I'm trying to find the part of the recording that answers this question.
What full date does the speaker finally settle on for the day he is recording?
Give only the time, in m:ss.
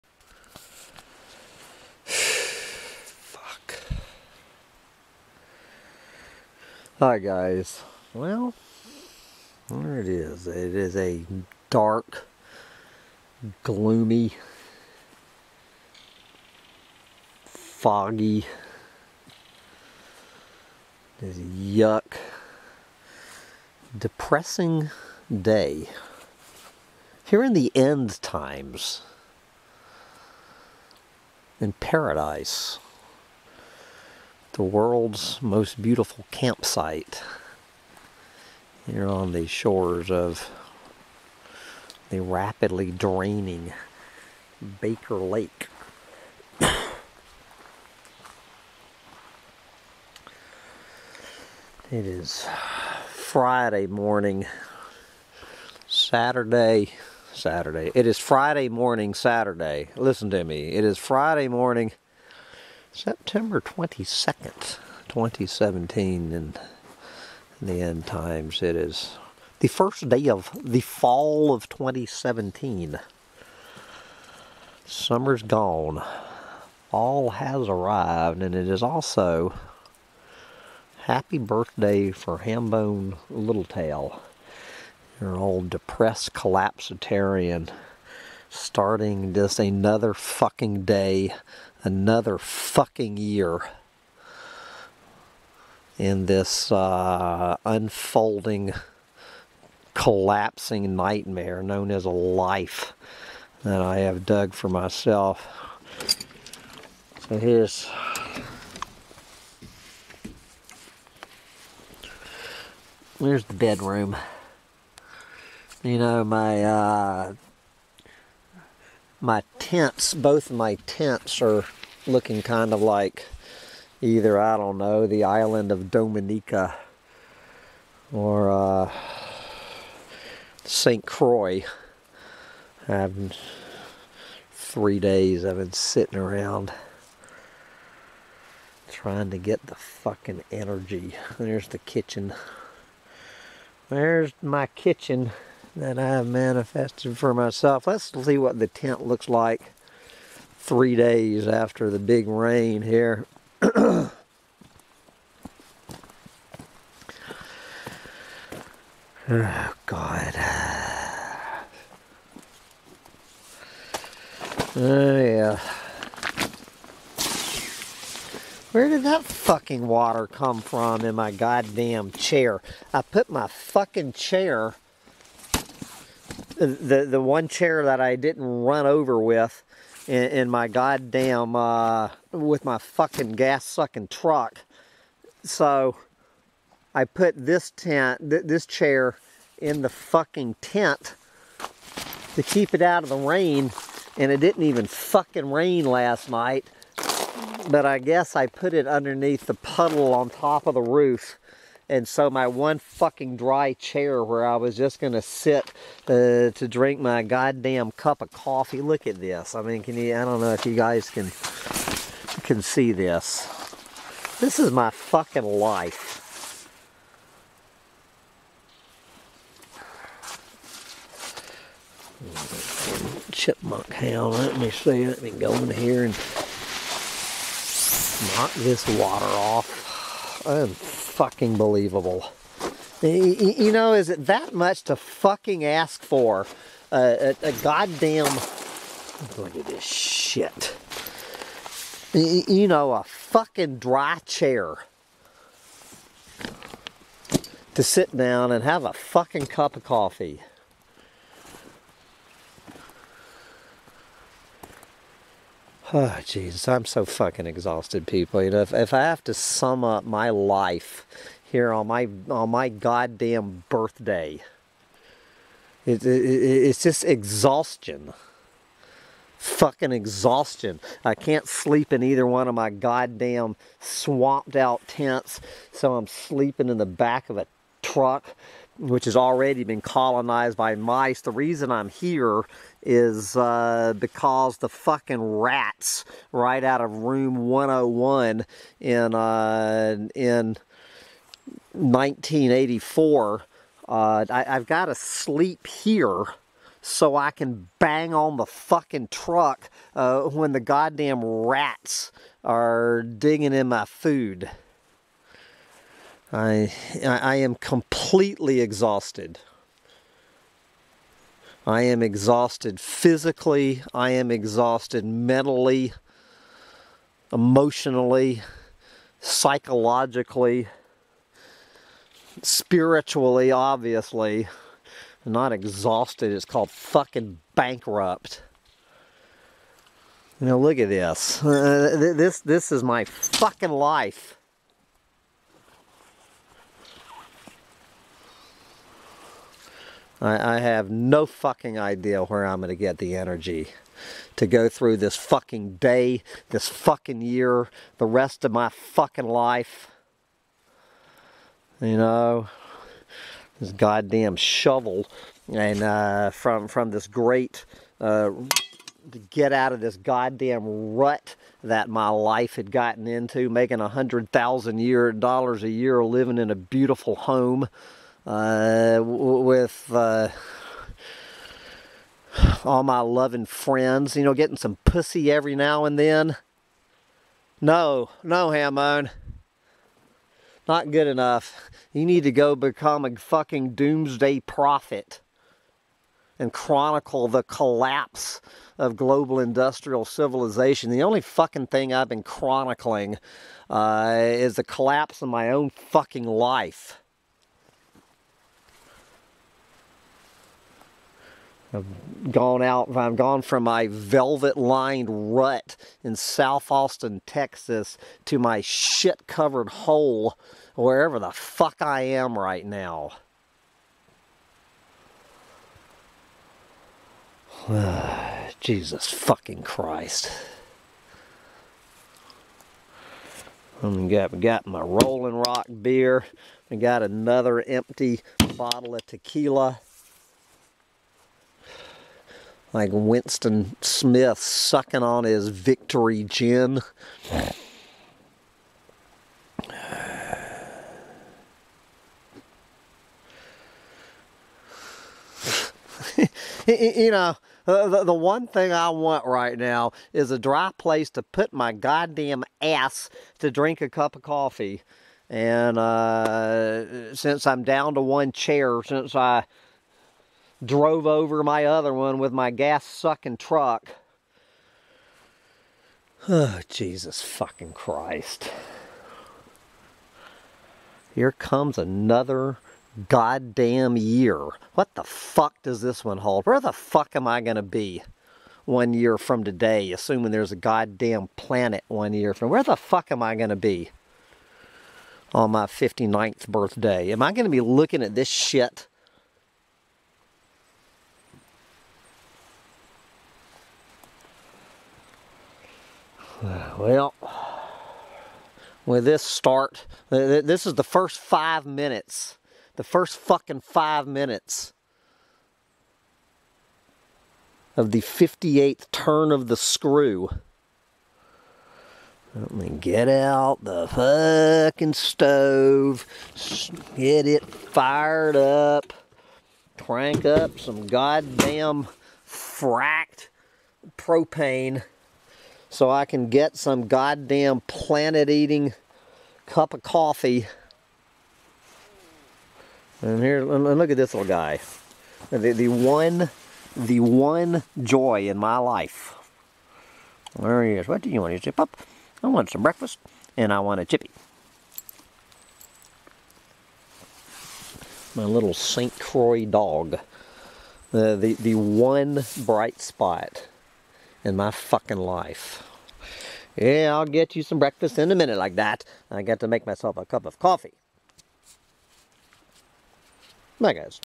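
1:02.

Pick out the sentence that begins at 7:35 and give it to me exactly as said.
And uh, since I'm down to one chair, since I drove over my other one with my gas sucking truck.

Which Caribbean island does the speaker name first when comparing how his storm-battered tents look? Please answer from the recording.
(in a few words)
Dominica.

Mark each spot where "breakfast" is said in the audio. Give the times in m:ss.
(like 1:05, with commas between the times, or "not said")
9:02, 9:17.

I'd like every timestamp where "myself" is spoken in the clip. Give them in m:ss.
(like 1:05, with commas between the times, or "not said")
1:44, 2:27, 9:19.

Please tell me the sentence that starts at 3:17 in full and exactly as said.
But I guess I put it underneath the puddle on top of the roof.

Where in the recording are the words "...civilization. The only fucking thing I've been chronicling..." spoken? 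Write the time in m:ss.
6:30.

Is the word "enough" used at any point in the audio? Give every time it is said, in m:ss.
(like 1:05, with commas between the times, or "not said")
6:21.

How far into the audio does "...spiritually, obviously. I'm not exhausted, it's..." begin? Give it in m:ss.
5:22.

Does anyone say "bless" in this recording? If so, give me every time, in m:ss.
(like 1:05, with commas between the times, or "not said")
not said.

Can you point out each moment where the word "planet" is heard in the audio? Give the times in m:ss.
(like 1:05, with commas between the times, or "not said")
8:01, 8:47.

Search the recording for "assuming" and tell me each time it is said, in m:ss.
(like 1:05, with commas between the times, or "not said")
7:59.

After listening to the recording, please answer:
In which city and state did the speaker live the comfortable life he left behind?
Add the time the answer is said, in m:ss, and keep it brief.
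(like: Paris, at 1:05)
South Austin, Texas, at 6:46.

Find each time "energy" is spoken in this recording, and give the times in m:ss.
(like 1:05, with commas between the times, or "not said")
2:20, 5:43.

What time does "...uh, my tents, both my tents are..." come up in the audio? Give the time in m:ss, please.
1:56.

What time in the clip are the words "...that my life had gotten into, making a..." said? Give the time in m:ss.
6:01.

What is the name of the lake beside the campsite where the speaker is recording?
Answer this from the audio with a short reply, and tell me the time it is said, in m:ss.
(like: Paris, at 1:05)
Baker Lake, at 0:44.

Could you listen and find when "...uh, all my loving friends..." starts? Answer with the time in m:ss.
6:09.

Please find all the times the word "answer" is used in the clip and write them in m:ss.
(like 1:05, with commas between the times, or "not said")
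not said.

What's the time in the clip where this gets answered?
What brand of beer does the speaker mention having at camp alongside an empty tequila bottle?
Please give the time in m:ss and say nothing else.
7:04.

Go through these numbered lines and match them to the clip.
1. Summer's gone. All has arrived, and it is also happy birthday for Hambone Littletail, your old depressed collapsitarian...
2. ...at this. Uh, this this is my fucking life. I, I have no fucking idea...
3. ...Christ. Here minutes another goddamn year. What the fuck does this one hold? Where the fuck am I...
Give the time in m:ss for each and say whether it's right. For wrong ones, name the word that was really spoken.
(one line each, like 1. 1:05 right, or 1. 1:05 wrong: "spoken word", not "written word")
1. 1:14 right
2. 5:30 right
3. 7:47 wrong: "comes", not "minutes".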